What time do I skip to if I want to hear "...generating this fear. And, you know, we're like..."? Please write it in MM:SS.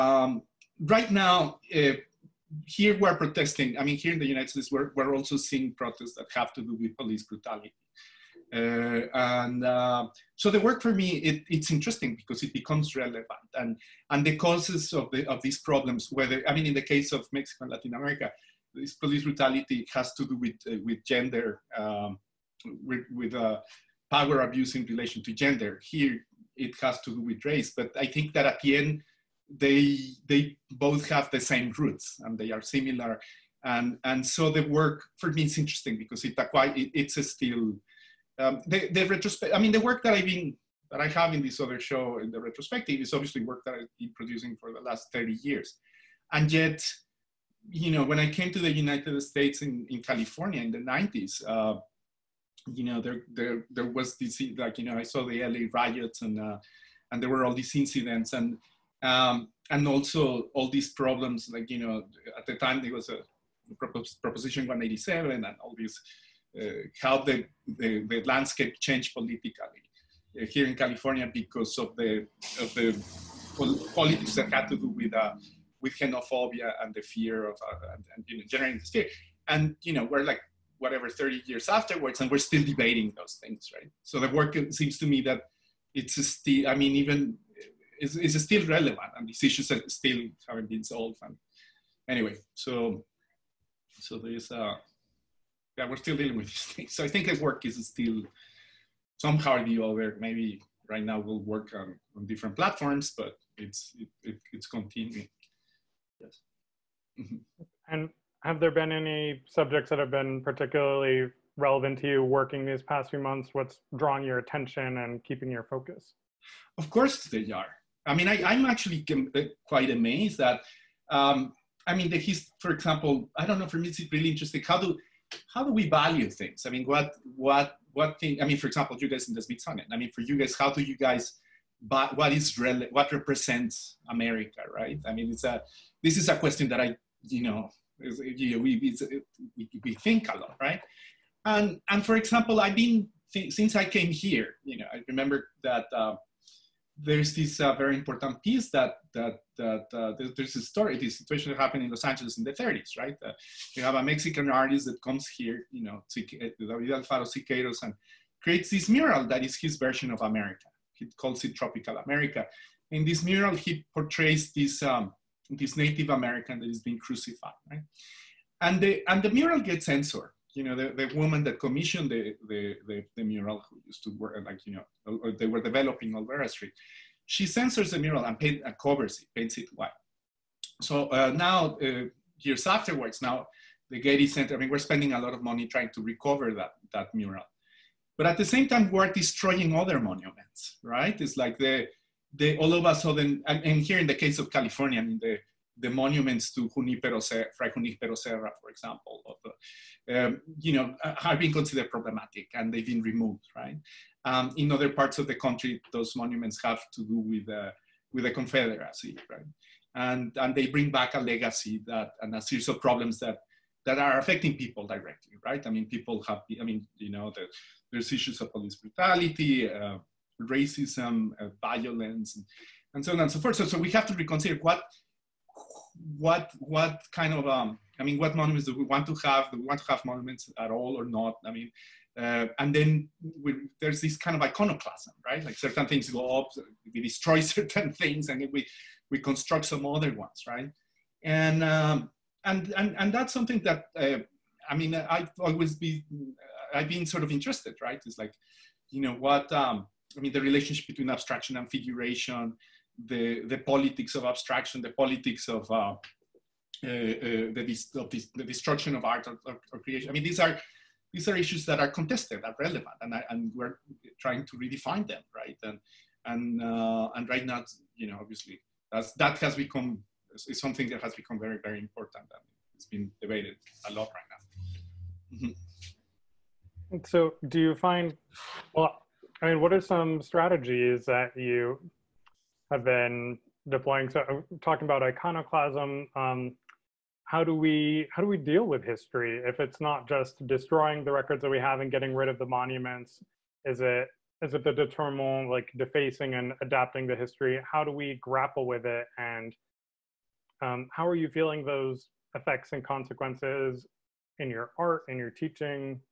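01:18.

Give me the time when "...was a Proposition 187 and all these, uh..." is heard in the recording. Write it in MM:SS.
01:02.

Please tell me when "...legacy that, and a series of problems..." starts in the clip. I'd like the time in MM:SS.
03:31.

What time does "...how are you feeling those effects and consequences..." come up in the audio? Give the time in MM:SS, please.
05:00.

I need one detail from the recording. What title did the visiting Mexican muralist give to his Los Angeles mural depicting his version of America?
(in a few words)
Tropical America.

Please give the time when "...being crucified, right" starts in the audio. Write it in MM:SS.
02:46.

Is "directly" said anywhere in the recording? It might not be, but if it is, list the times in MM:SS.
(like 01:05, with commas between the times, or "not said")
03:34.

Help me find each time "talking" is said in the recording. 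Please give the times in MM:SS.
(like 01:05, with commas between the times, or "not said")
04:44.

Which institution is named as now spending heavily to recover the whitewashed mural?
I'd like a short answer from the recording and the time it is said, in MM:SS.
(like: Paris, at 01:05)
the Getty Center, at 03:03.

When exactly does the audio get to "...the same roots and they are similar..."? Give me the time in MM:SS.
00:31.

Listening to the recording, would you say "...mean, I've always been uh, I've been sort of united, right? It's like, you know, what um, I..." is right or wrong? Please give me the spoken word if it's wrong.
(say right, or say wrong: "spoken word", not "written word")
wrong: "interested", not "united".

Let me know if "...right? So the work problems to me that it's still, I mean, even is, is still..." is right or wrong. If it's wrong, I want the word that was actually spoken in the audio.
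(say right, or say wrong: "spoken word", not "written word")
wrong: "seems", not "problems".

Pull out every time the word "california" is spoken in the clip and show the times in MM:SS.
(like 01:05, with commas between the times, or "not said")
00:50, 01:10, 03:14.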